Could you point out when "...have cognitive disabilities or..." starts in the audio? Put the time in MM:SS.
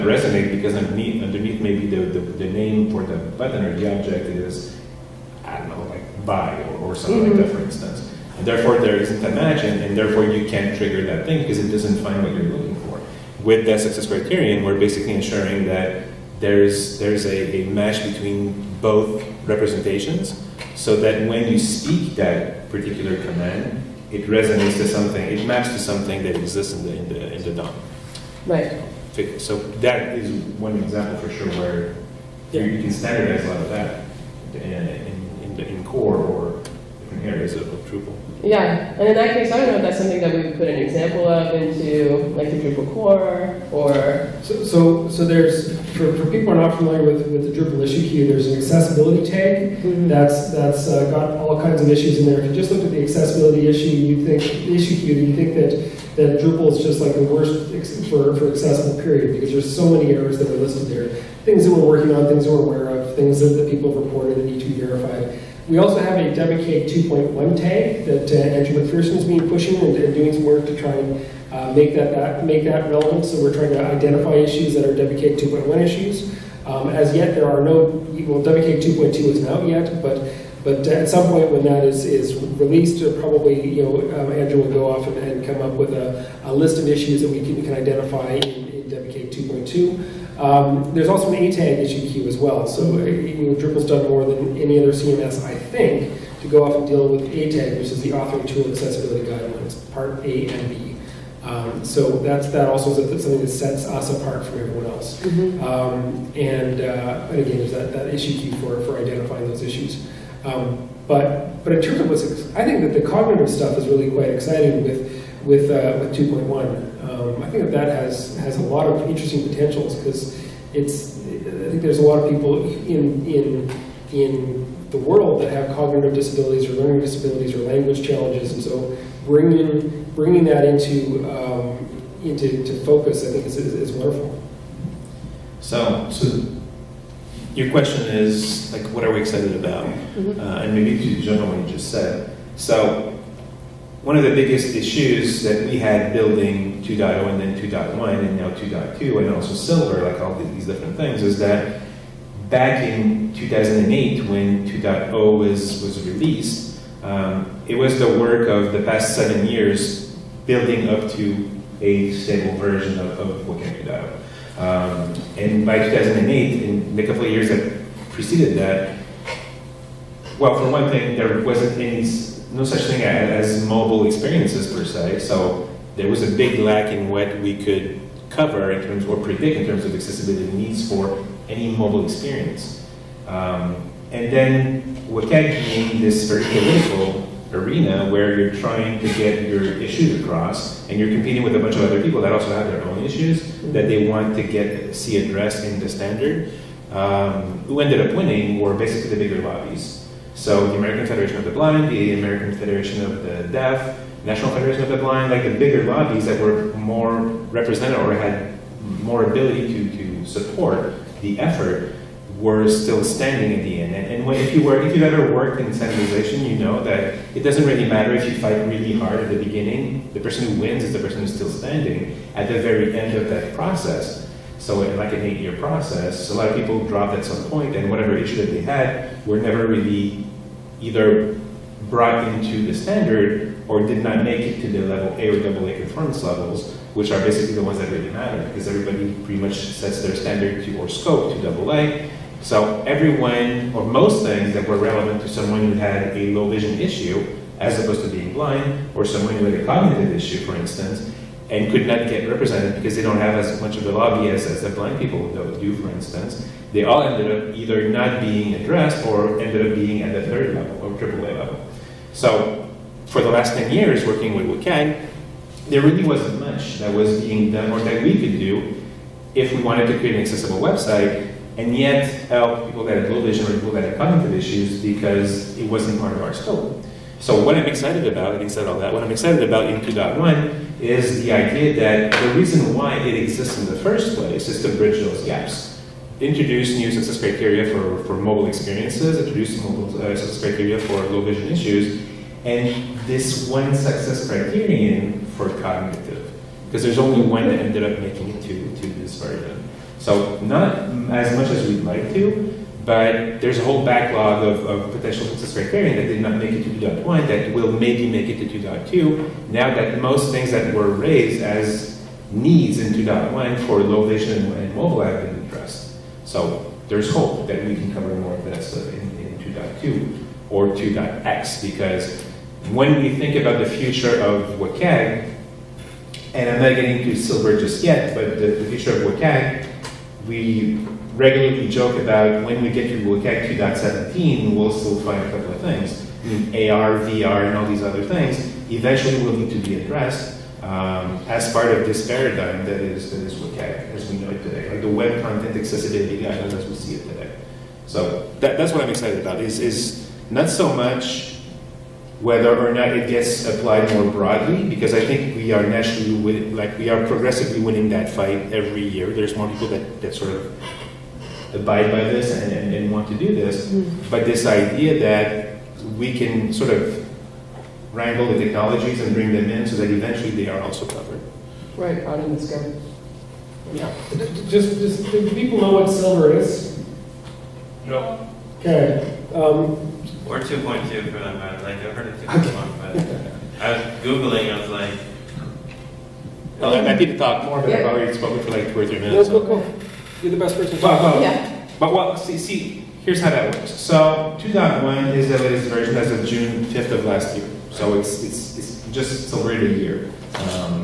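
02:05.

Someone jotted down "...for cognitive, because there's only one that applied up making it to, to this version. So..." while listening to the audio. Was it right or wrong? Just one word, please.
wrong.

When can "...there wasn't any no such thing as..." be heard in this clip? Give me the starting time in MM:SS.
02:51.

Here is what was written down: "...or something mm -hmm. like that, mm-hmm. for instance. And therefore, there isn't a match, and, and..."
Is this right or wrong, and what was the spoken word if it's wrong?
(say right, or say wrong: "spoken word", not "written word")
right.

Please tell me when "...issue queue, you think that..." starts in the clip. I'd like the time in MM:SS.
00:54.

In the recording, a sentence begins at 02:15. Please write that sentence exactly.
So, so your question is like, what are we excited about?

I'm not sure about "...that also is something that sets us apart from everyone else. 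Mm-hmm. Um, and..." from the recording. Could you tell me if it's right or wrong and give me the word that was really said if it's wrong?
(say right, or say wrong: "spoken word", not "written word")
right.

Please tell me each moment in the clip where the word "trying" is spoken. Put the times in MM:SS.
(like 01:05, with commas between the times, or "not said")
01:13, 03:08.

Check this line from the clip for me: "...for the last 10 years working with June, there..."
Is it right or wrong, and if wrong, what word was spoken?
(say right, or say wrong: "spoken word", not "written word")
wrong: "WCAG", not "June".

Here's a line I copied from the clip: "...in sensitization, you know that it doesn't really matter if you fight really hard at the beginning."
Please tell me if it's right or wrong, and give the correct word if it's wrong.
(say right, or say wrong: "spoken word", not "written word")
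right.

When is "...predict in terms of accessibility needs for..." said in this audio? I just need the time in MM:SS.
02:59.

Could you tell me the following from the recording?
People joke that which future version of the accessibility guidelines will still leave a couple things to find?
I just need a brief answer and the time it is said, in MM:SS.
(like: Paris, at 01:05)
2.17, at 05:33.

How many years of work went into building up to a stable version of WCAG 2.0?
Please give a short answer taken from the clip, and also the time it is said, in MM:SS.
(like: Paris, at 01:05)
7, at 02:39.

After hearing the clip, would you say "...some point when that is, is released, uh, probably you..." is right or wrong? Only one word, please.
right.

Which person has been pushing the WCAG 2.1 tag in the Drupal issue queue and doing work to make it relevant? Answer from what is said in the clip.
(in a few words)
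Andrew McPherson.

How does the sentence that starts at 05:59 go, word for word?
There's more people that, that sort of abide by this and, and, and want to do this.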